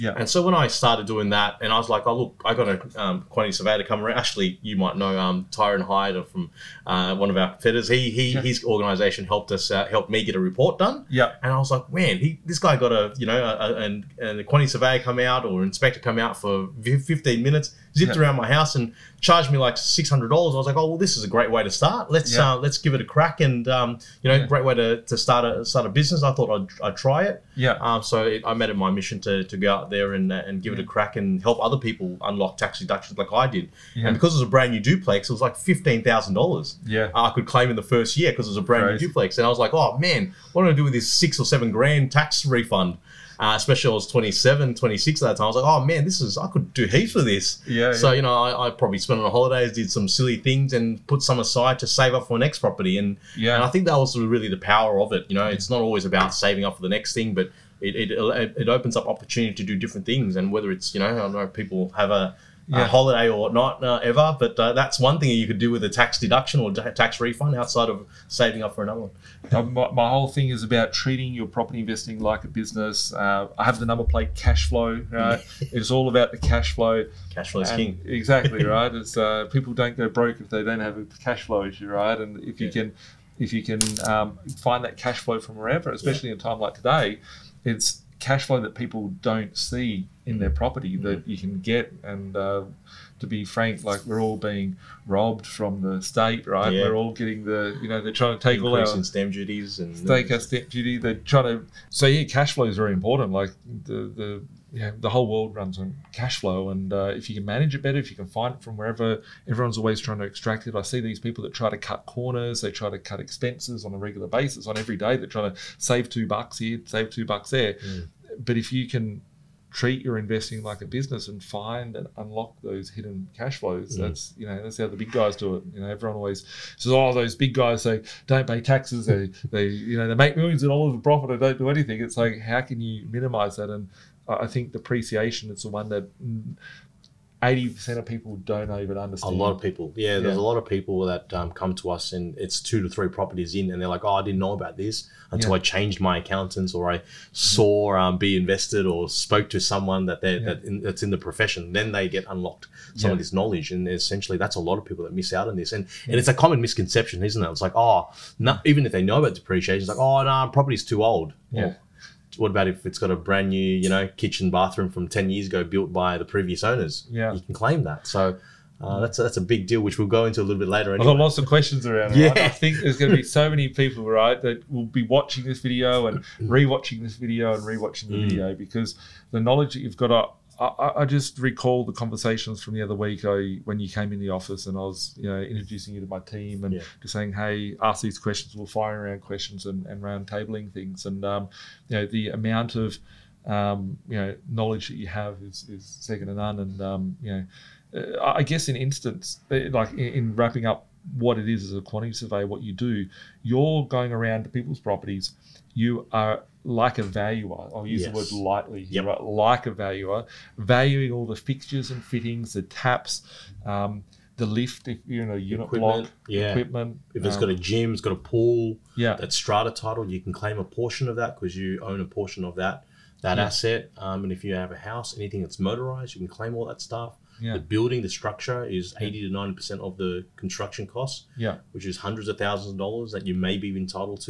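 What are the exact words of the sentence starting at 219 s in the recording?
that strata title, you can claim a portion of that because you own a portion of that that yeah.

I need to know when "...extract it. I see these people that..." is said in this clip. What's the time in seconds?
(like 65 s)
110 s.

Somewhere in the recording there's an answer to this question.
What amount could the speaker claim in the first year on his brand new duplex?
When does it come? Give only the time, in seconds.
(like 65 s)
35 s.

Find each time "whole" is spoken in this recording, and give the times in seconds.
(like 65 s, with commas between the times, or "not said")
70 s, 105 s.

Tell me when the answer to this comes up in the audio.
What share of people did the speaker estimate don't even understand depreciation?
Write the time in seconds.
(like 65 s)
137 s.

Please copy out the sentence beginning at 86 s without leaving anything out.
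in a time like today, it's cash flow that people don't see in their property mm-hmm.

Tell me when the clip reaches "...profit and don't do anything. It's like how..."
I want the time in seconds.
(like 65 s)
131 s.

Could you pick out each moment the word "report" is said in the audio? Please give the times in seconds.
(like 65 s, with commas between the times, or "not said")
10 s.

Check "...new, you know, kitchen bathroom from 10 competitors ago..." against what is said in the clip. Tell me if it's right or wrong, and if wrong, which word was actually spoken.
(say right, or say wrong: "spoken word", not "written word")
wrong: "years", not "competitors".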